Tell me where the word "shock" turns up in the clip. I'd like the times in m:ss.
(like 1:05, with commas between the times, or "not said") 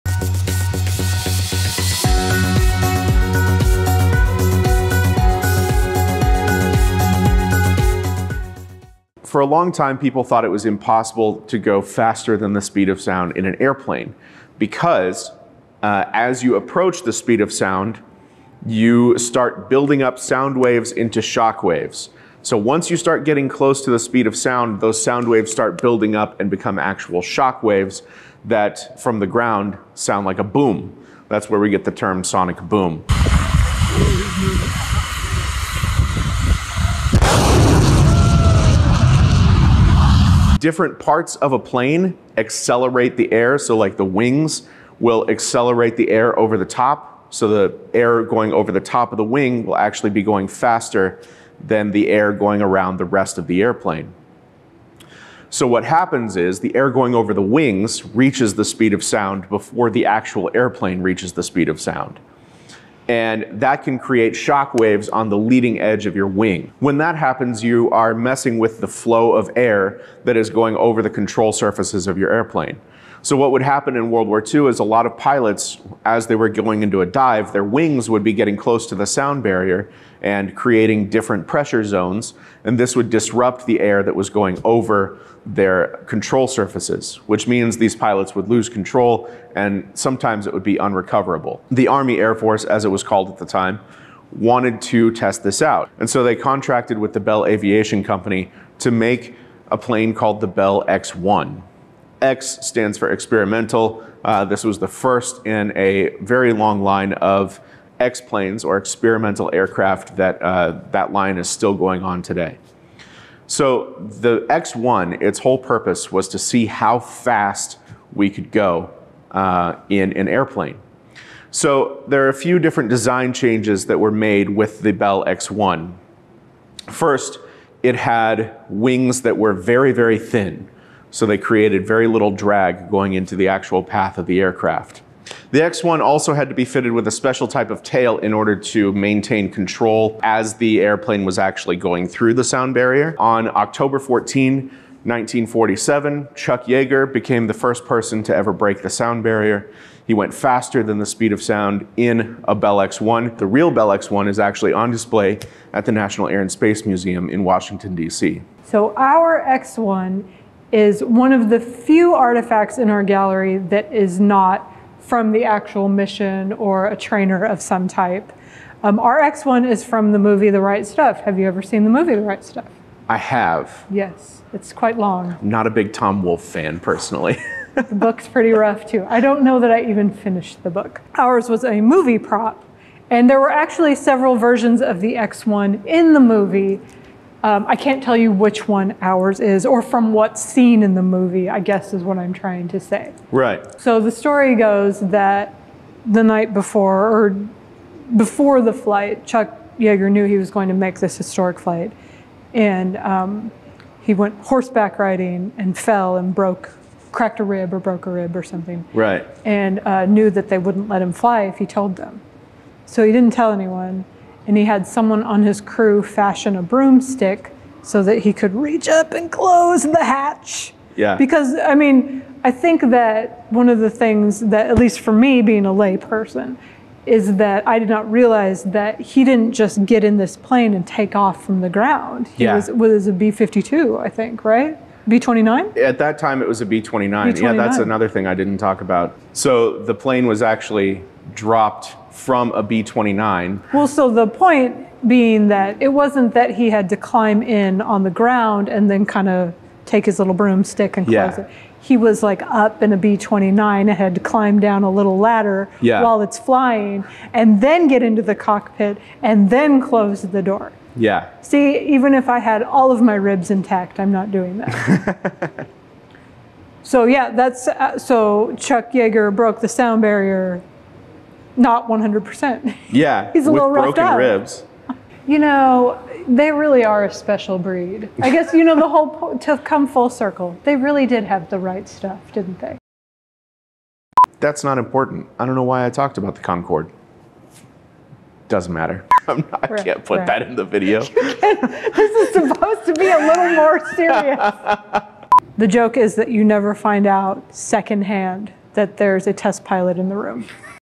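0:21, 0:27, 1:04.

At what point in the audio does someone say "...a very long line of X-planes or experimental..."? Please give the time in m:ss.
1:45.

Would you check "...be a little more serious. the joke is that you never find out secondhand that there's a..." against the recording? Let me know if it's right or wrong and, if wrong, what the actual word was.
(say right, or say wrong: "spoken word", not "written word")
right.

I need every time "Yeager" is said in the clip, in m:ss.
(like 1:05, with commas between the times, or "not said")
2:26, 3:19, 4:28.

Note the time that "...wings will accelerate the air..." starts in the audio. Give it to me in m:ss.
0:44.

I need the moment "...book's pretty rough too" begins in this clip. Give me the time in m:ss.
2:57.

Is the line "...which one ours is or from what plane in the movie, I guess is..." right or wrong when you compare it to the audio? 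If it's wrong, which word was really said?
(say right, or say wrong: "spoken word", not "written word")
wrong: "scene", not "plane".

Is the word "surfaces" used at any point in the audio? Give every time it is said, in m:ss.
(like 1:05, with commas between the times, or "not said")
1:11, 1:26.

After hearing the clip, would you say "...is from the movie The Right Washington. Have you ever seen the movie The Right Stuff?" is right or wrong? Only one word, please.
wrong.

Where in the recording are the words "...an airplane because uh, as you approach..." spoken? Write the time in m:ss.
0:13.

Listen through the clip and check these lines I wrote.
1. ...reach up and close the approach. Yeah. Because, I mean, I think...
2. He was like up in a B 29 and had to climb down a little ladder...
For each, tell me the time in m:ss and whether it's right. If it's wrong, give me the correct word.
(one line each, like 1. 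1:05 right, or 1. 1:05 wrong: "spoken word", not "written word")
1. 3:38 wrong: "hatch", not "approach"
2. 4:11 right.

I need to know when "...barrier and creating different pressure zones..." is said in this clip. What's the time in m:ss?
1:19.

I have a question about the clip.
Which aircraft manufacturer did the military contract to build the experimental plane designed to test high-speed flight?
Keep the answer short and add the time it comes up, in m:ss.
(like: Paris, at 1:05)
Bell Aviation Company, at 1:37.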